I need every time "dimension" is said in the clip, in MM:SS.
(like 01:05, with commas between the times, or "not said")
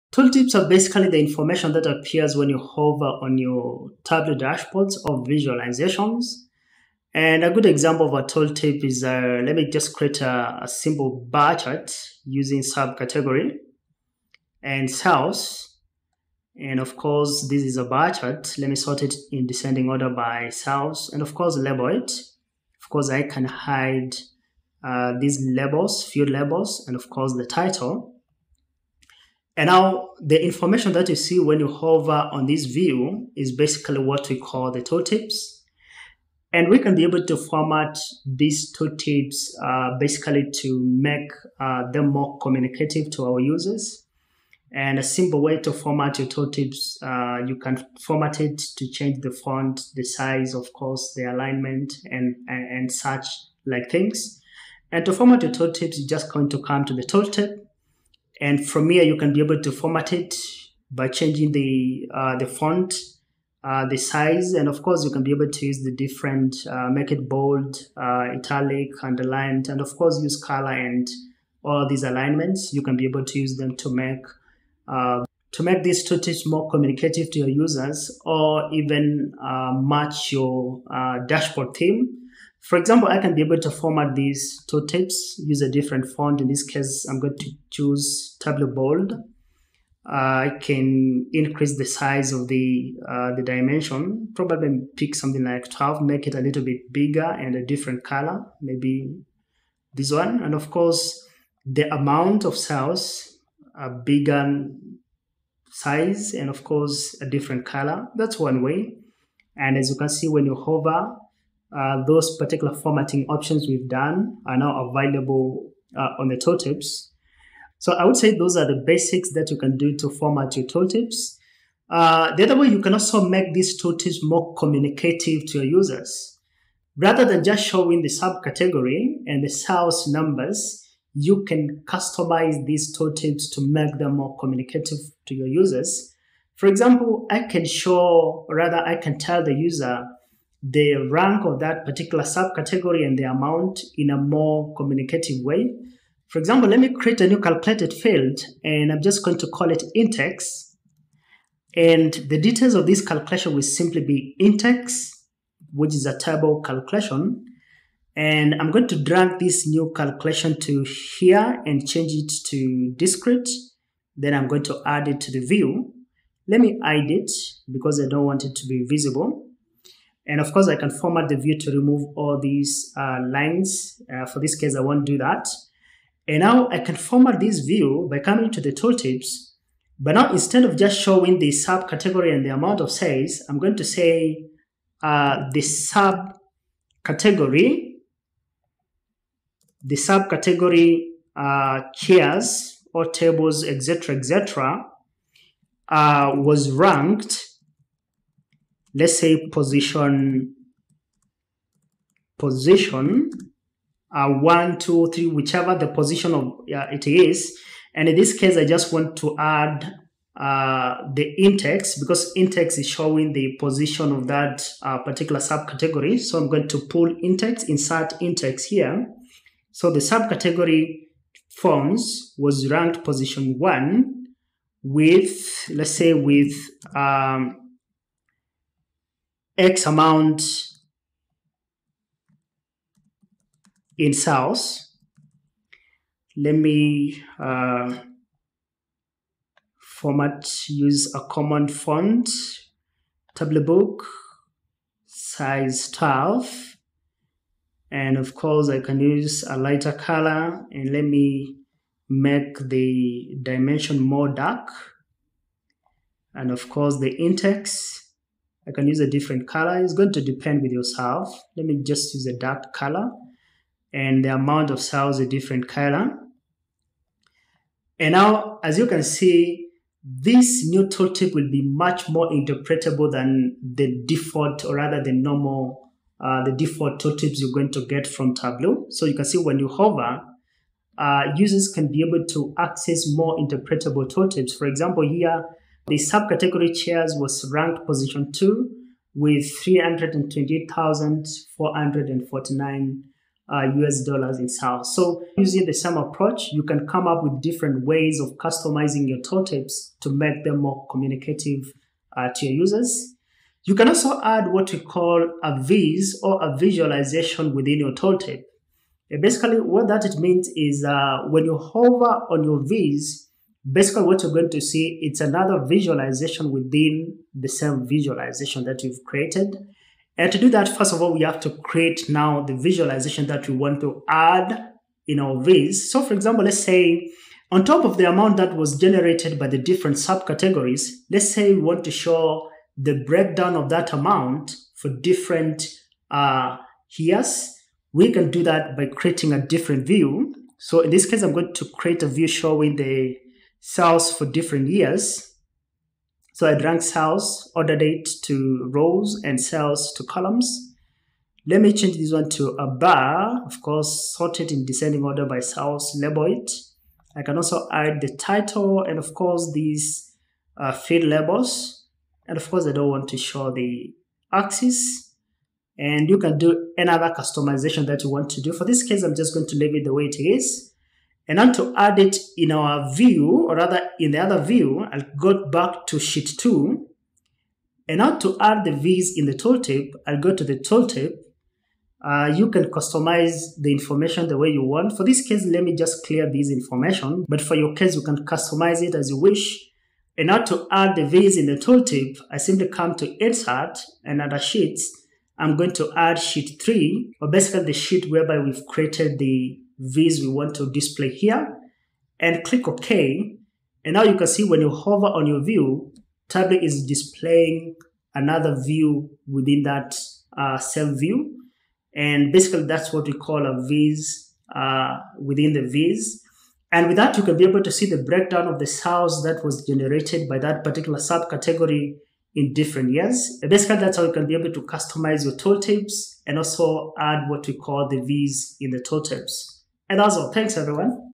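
01:33, 04:13.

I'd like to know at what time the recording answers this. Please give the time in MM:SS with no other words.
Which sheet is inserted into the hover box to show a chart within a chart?
06:36.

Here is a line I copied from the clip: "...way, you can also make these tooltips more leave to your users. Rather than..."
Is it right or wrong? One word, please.
wrong.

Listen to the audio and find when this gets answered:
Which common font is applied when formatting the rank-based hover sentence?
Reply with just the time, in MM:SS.
04:03.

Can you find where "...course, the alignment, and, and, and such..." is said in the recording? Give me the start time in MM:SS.
00:50.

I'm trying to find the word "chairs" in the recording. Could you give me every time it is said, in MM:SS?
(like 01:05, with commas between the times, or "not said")
03:11, 04:46.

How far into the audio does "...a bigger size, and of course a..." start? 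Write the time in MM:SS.
01:43.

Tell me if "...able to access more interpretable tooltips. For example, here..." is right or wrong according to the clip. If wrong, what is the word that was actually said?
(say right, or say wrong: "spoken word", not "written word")
right.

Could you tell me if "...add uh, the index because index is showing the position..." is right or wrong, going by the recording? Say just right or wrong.
right.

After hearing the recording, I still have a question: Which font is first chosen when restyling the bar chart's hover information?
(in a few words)
Tableau Bold.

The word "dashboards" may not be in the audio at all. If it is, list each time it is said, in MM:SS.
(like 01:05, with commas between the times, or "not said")
00:04, 01:21.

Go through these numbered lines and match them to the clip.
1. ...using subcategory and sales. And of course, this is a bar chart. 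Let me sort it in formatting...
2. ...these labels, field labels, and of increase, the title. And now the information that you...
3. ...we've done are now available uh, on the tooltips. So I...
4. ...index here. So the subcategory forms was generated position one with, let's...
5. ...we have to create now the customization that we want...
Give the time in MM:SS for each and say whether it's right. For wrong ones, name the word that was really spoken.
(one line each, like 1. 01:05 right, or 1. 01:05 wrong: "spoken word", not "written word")
1. 00:12 wrong: "descending", not "formatting"
2. 00:25 wrong: "course", not "increase"
3. 01:53 right
4. 03:38 wrong: "ranked", not "generated"
5. 05:21 wrong: "visualization", not "customization".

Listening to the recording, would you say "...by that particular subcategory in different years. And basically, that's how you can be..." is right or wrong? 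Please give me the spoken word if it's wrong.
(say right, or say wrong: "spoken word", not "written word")
right.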